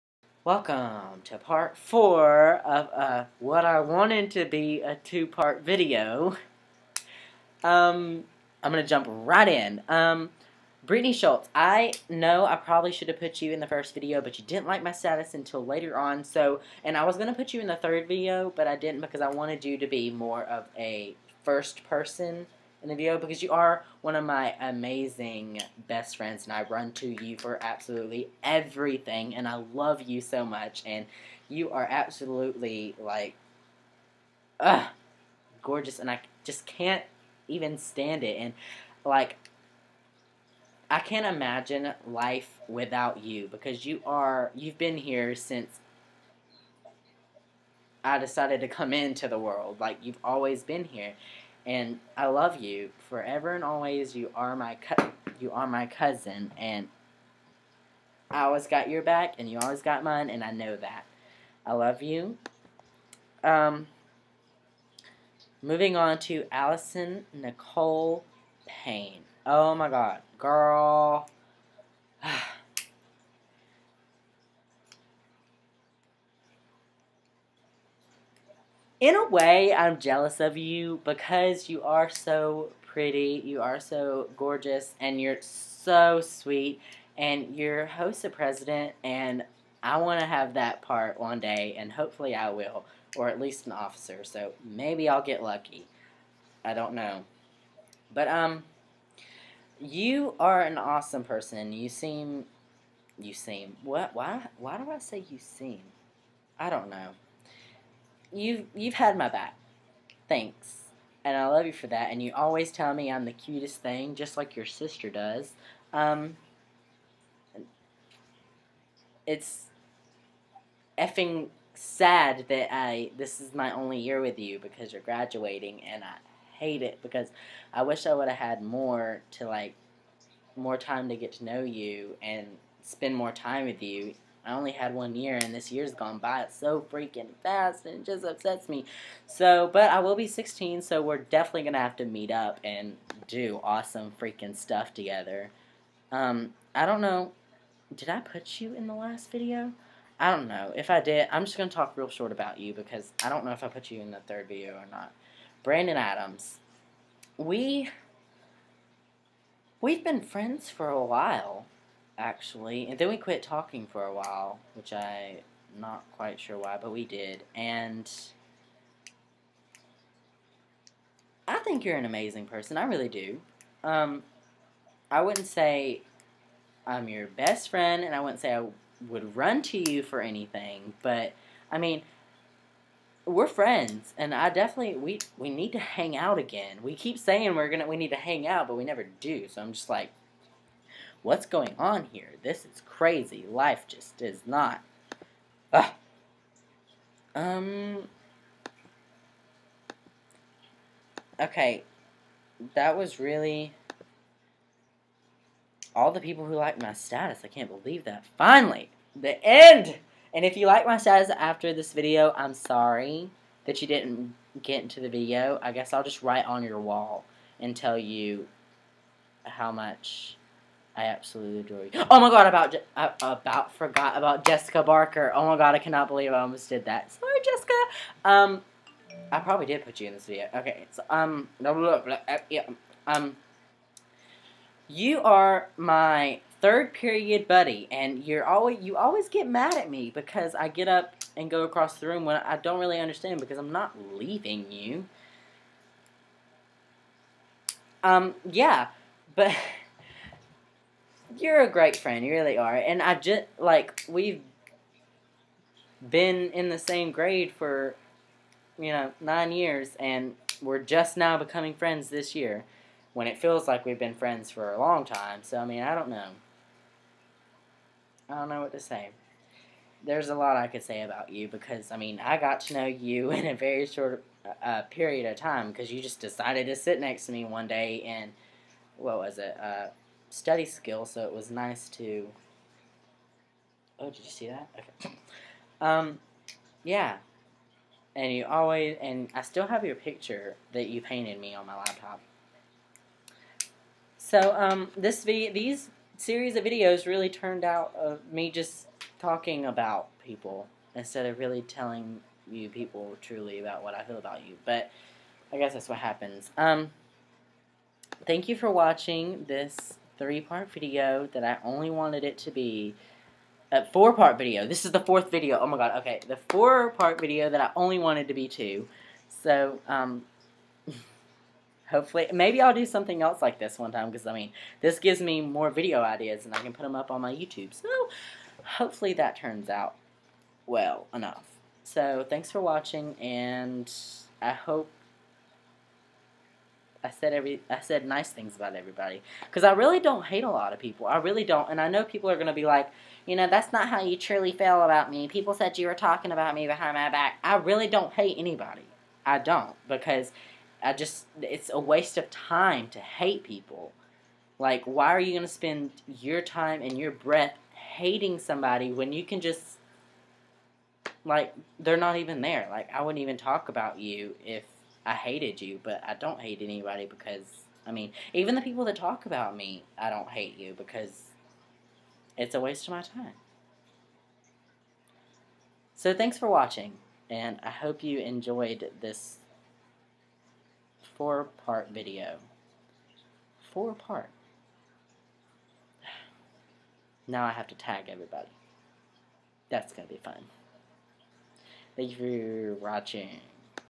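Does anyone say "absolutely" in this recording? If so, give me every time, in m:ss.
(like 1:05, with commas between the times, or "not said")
0:27, 0:31, 3:41.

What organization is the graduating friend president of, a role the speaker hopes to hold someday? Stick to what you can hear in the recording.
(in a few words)
HOSA.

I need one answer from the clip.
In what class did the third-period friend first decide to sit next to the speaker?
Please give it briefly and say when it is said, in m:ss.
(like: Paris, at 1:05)
Study skill, at 4:40.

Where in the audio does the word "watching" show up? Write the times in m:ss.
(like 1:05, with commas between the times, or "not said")
5:08, 5:32, 6:16, 6:32.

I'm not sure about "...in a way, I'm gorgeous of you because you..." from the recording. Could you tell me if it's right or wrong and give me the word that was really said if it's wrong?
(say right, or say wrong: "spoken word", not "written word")
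wrong: "jealous", not "gorgeous".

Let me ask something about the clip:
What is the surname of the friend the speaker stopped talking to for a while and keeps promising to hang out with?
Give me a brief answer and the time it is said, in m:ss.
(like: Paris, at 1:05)
Adams, at 2:35.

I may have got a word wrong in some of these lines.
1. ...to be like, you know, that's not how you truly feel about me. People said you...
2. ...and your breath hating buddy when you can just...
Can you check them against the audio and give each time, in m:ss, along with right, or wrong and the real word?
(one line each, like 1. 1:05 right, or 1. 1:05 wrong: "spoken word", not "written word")
1. 5:42 right
2. 5:56 wrong: "somebody", not "buddy".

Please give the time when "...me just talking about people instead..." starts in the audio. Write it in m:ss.
4:58.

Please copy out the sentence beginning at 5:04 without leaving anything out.
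But I guess that's what happens.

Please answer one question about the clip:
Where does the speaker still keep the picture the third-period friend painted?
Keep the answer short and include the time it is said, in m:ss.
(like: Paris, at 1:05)
On my laptop, at 4:51.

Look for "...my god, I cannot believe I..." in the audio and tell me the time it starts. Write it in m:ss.
3:45.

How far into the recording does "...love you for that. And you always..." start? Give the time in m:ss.
1:51.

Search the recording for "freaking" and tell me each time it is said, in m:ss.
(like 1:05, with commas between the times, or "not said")
2:16, 2:24.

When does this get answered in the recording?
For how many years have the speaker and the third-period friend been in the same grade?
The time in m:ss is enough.
4:19.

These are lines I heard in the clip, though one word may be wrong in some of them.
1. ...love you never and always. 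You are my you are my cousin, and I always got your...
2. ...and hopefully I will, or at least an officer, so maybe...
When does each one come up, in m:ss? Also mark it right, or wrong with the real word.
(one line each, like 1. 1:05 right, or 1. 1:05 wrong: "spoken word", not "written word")
1. 0:52 wrong: "forever", not "never"
2. 1:31 right.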